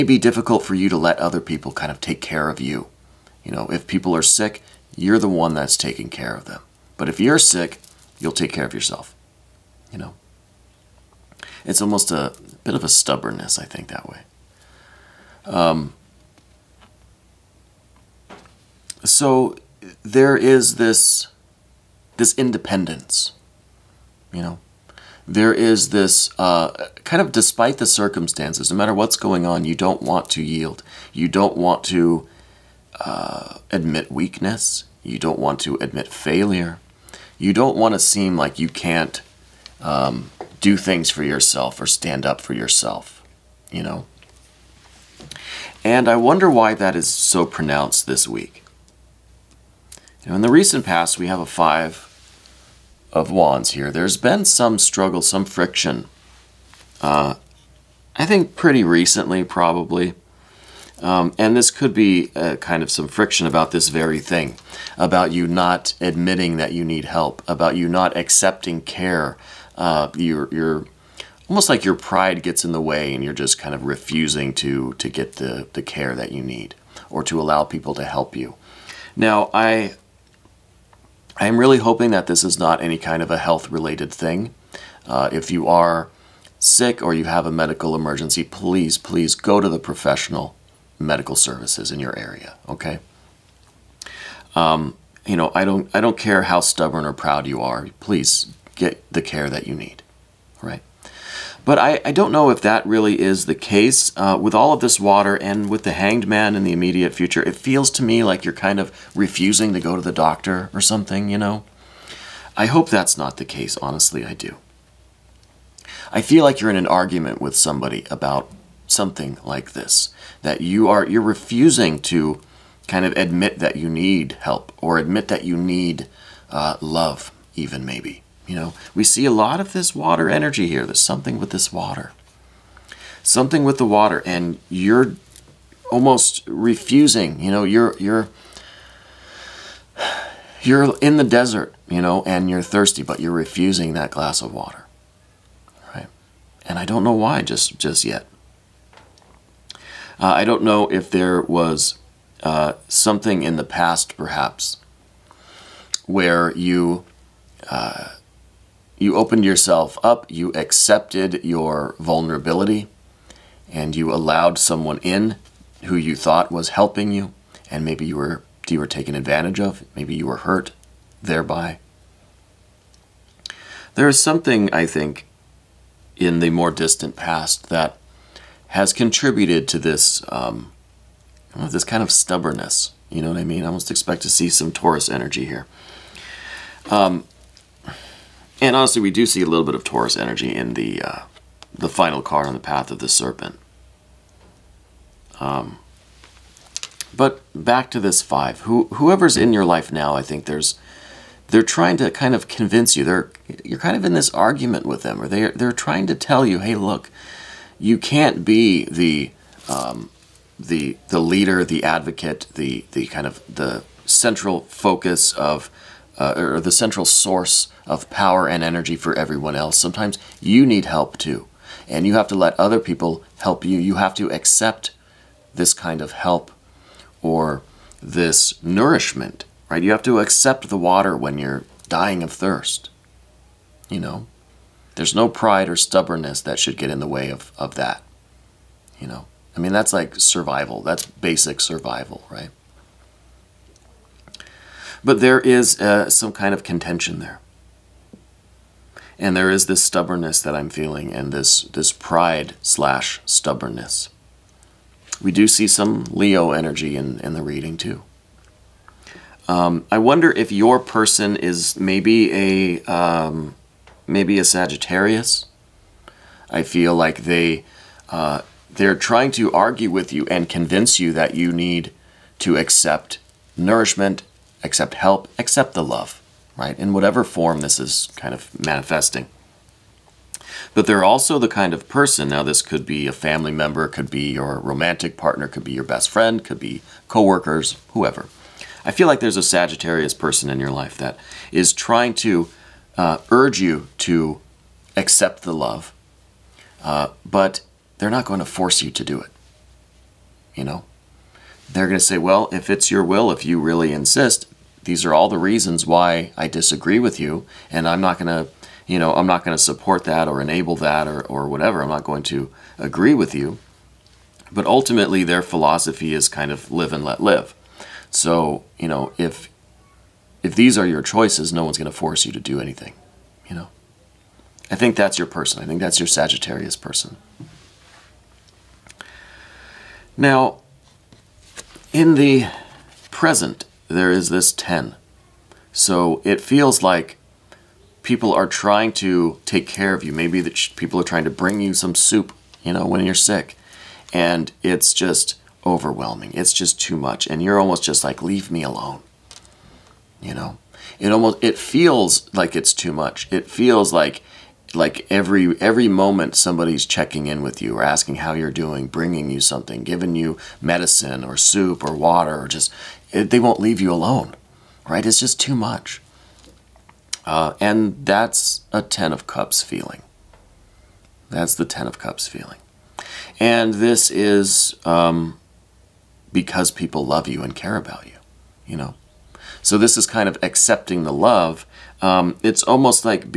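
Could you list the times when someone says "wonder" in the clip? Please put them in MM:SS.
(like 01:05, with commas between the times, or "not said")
00:46, 04:19.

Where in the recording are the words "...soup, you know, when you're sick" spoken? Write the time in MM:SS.
05:41.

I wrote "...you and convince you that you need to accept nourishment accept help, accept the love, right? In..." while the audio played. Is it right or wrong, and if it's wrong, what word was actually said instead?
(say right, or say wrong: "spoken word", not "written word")
right.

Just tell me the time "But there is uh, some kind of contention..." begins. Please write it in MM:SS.
04:05.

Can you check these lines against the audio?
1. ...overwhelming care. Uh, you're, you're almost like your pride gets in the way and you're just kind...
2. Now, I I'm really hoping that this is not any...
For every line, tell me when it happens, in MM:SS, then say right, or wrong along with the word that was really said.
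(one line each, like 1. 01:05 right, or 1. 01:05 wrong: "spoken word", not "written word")
1. 01:08 wrong: "accepting", not "overwhelming"
2. 01:19 right.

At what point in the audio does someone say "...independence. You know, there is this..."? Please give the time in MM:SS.
00:22.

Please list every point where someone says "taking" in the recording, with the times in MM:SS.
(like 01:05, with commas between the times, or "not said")
00:05.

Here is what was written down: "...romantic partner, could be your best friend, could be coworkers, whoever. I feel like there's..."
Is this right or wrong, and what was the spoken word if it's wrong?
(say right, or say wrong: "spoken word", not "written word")
right.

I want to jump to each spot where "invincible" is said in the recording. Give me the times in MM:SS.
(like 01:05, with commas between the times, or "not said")
not said.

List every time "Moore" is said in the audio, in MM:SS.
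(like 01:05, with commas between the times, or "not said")
not said.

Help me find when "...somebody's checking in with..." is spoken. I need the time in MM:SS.
05:56.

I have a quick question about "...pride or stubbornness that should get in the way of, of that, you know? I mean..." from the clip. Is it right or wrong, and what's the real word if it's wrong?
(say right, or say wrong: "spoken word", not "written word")
right.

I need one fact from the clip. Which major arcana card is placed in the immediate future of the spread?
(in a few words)
The Hanged Man.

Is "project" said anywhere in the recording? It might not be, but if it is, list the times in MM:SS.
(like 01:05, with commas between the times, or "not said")
not said.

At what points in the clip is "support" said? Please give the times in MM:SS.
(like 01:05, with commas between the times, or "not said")
05:09.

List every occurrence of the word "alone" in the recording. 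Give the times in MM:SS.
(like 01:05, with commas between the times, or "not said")
05:48, 06:03.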